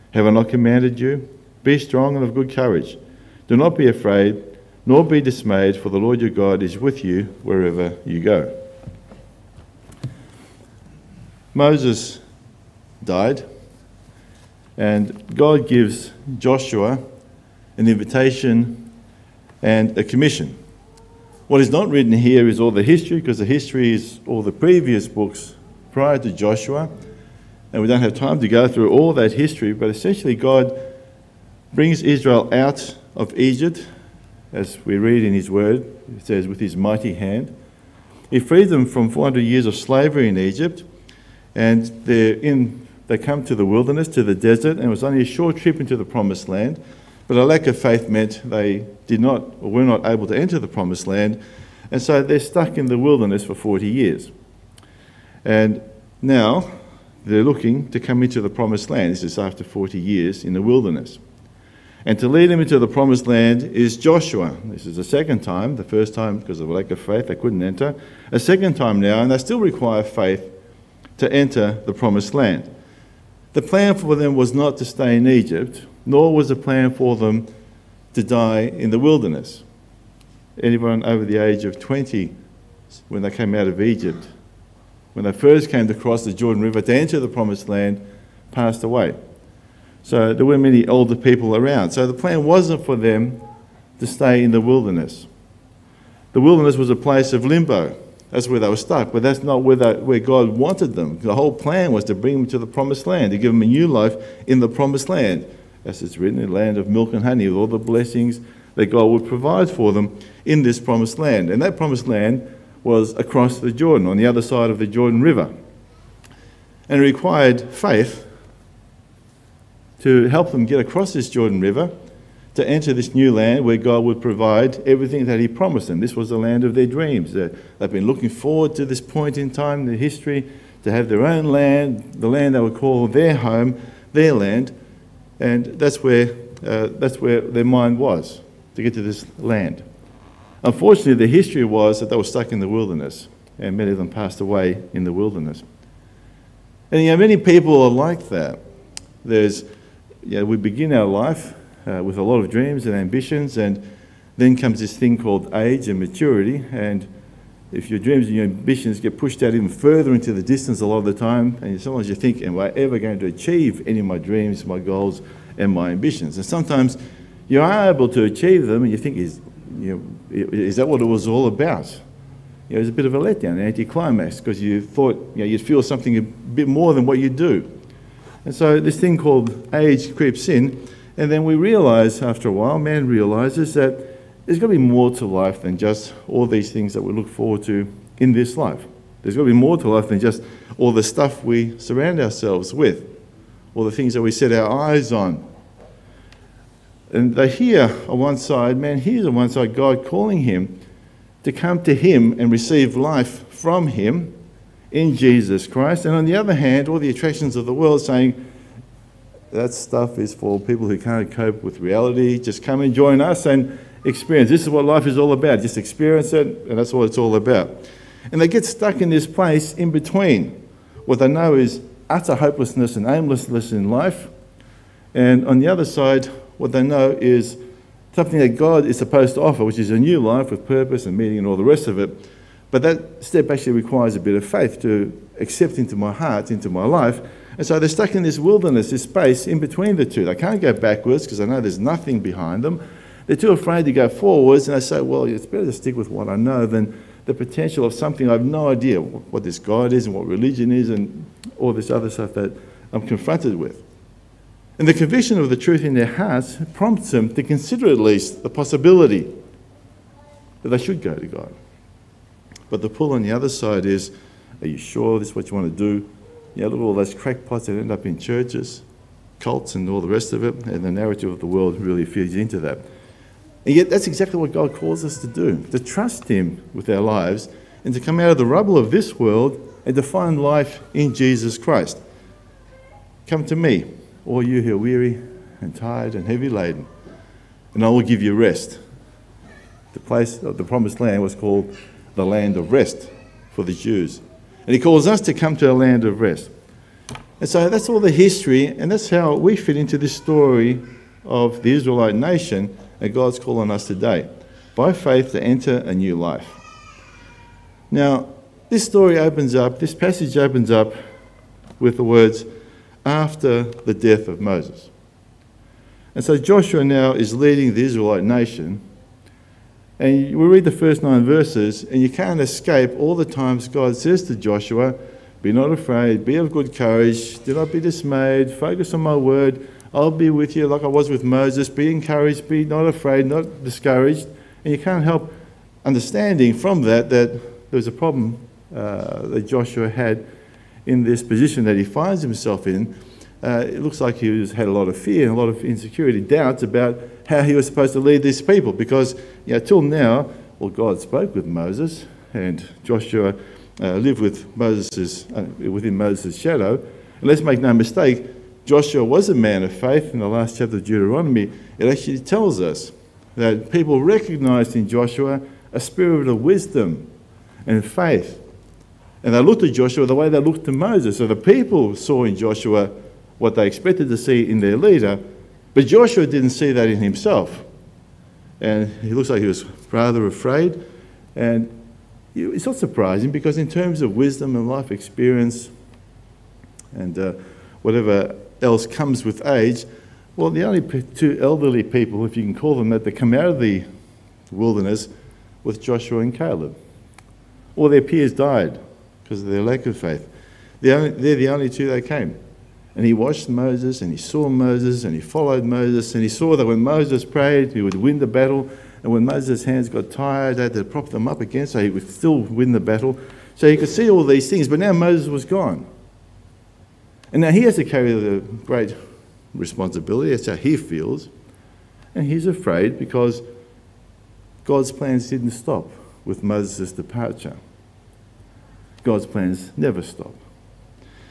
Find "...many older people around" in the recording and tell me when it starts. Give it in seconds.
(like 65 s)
90 s.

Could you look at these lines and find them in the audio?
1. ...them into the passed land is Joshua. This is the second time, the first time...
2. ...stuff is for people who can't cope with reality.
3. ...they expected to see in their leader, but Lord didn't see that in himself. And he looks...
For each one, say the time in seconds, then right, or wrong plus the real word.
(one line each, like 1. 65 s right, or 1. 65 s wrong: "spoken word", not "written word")
1. 62 s wrong: "promised", not "passed"
2. 209 s right
3. 373 s wrong: "Joshua", not "Lord".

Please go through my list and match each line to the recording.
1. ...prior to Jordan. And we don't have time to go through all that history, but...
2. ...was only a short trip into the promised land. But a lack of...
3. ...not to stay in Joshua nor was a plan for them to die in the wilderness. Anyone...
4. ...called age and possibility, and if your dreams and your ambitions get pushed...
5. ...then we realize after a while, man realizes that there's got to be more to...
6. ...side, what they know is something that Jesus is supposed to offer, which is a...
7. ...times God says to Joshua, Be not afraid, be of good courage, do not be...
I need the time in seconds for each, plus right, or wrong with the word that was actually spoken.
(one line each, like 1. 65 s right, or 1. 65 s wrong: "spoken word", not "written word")
1. 25 s wrong: "Joshua", not "Jordan"
2. 44 s right
3. 74 s wrong: "Egypt", not "Joshua"
4. 155 s wrong: "maturity", not "possibility"
5. 181 s right
6. 225 s wrong: "God", not "Jesus"
7. 323 s right.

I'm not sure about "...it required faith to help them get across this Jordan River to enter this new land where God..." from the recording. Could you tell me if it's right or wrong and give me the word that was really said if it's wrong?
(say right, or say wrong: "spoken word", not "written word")
right.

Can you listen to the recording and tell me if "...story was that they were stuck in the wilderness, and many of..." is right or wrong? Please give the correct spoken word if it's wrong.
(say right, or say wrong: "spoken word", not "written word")
wrong: "history", not "story".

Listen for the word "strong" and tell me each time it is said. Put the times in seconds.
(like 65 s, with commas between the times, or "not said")
1 s.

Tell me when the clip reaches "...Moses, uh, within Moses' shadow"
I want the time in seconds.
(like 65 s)
354 s.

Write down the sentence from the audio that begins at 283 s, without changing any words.
Come to me, all you who are weary and tired and heavy laden, and I will give you rest.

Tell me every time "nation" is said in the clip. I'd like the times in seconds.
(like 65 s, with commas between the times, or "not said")
302 s, 318 s.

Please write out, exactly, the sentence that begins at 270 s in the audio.
And the narrative of the world really feeds into that.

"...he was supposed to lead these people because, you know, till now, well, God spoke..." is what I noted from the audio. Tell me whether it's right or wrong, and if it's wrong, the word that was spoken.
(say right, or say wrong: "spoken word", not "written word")
right.